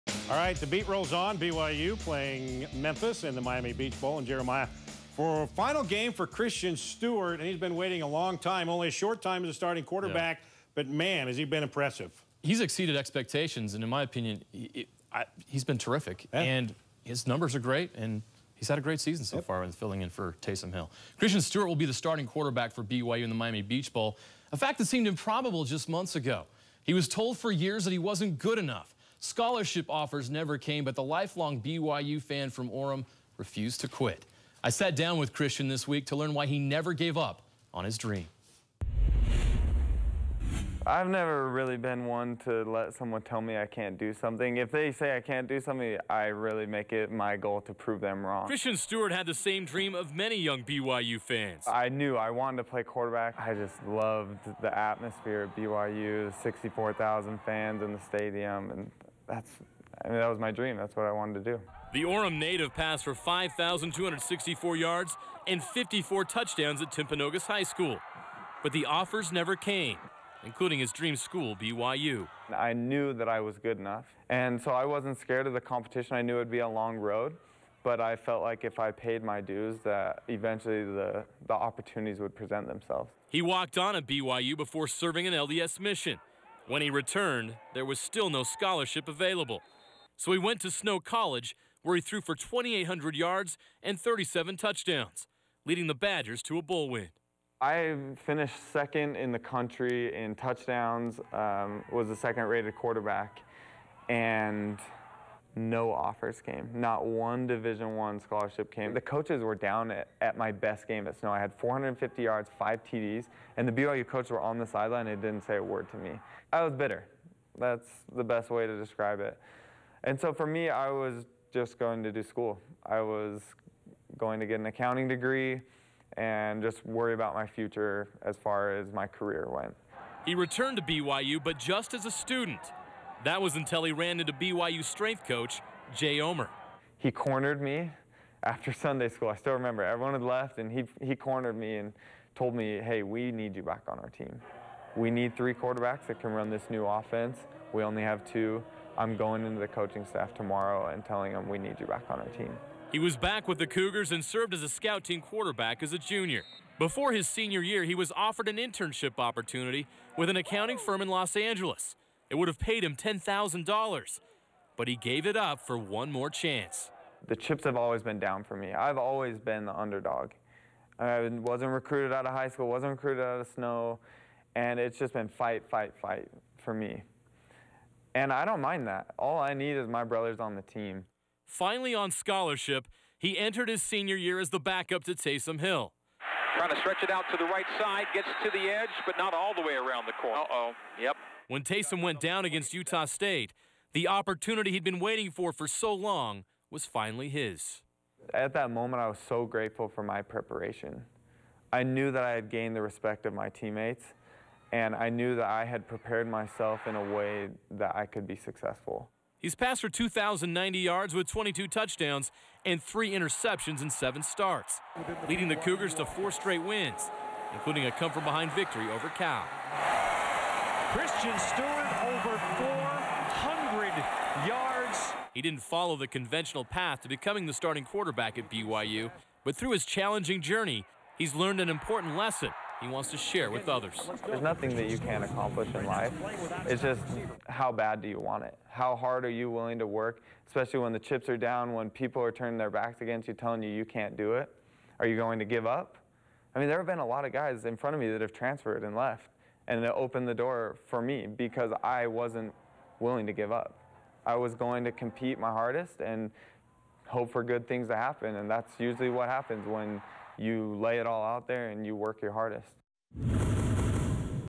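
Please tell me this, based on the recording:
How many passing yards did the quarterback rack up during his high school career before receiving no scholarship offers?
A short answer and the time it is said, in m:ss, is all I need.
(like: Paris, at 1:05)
5,264, at 1:03.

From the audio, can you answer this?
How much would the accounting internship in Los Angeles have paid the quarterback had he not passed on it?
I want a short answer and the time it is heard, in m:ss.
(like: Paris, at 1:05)
$10,000, at 2:42.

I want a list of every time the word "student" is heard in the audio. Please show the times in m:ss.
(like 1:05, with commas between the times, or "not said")
2:12.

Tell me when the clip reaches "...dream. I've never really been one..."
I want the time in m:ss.
0:37.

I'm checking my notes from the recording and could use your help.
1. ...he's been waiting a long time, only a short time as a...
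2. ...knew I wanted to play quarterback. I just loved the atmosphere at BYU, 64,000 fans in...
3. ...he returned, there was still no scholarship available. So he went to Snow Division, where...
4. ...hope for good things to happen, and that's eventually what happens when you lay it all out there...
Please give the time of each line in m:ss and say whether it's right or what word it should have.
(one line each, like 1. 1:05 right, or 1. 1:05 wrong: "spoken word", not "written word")
1. 0:07 right
2. 0:51 right
3. 1:26 wrong: "College", not "Division"
4. 4:17 wrong: "usually", not "eventually".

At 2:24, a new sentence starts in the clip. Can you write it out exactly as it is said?
We need three quarterbacks that can run this new offense.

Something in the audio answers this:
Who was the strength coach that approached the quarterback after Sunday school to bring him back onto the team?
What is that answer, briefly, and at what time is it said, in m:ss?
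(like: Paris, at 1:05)
Jay Omer, at 2:15.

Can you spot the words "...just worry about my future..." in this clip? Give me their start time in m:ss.
2:06.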